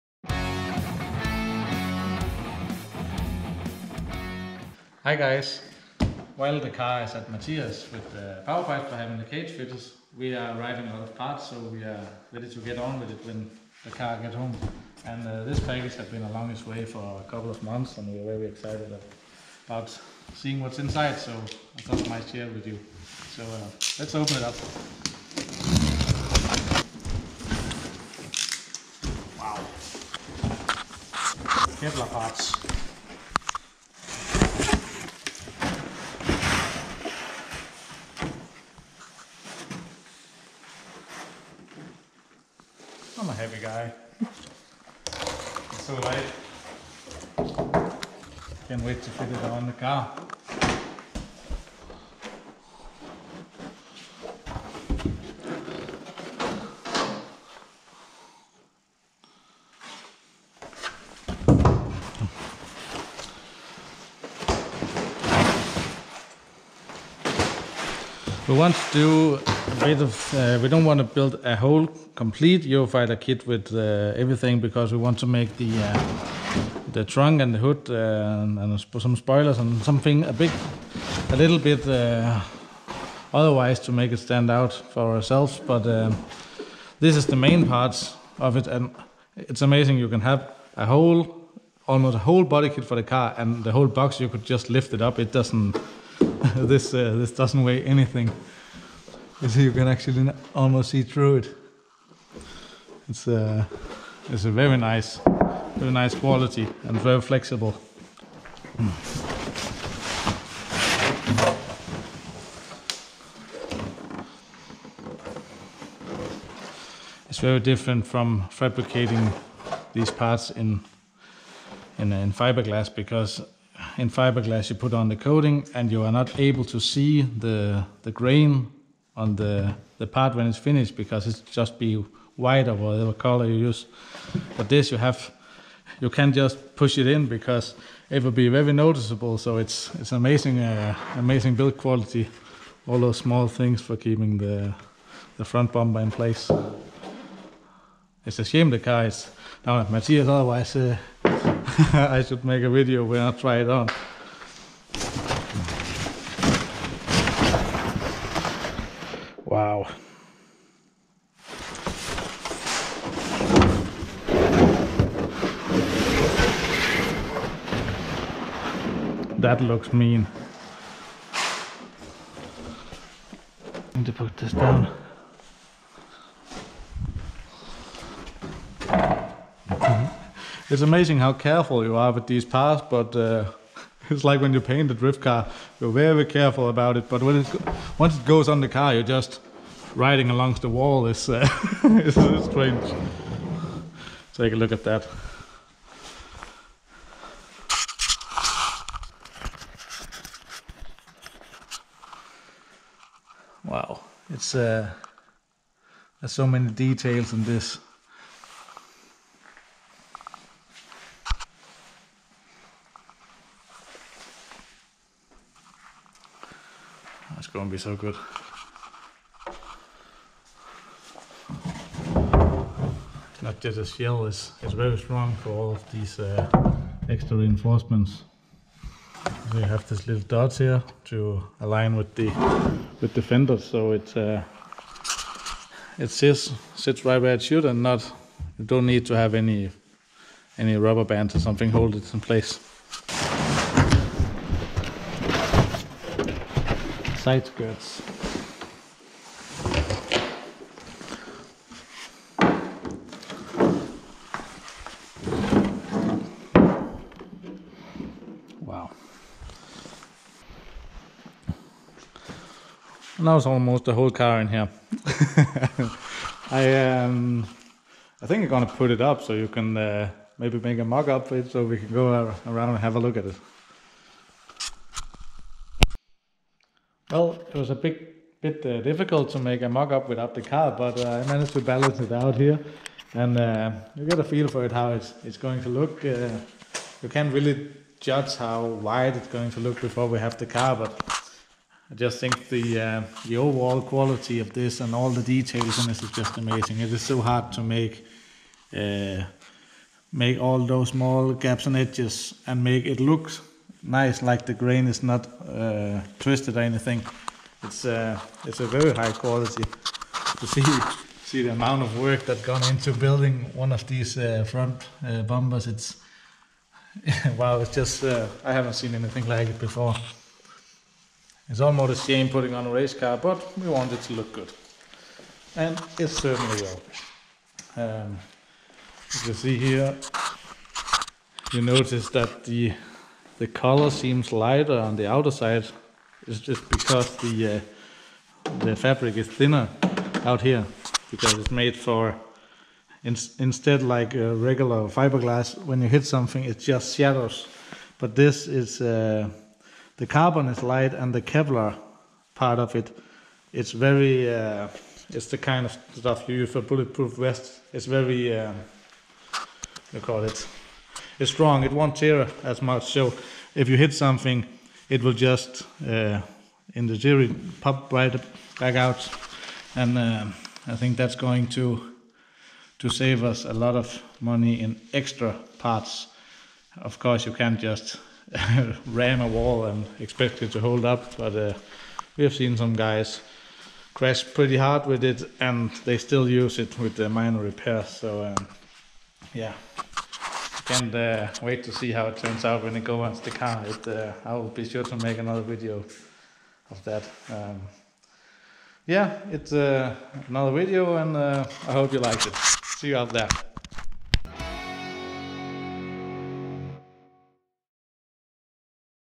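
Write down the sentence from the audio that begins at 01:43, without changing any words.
It's a, uh, it's a very nice, very nice quality and very flexible.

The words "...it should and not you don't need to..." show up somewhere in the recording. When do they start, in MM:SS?
03:57.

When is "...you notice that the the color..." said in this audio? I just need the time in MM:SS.
05:31.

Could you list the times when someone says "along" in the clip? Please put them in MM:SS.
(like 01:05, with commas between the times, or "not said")
00:16, 03:10.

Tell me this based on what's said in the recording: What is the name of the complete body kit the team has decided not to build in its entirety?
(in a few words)
Eurofighter.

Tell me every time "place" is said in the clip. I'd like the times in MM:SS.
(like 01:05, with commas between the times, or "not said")
02:26, 04:02.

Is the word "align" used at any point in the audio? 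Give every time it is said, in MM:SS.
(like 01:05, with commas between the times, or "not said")
03:51.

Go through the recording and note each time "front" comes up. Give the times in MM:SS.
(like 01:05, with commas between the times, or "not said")
02:25, 05:14.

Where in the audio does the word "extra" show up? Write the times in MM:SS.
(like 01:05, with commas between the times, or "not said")
03:47, 06:14.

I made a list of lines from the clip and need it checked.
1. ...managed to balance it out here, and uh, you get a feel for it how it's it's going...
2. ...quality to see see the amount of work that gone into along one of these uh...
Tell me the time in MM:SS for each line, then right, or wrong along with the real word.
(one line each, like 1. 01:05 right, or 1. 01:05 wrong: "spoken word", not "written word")
1. 04:41 right
2. 05:09 wrong: "building", not "along".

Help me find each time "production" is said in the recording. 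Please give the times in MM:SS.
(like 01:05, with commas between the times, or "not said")
not said.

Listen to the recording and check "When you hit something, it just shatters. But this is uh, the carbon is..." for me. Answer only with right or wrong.
right.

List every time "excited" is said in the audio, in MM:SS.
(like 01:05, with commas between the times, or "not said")
00:18.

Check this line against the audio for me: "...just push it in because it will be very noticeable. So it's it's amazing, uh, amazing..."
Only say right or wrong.
right.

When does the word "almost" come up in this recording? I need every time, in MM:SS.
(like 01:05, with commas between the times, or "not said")
01:31, 01:40, 04:23, 05:21.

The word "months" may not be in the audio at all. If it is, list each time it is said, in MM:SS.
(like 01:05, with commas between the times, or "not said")
00:17.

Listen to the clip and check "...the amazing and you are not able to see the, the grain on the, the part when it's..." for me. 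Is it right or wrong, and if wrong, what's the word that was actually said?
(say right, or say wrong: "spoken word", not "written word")
wrong: "coating", not "amazing".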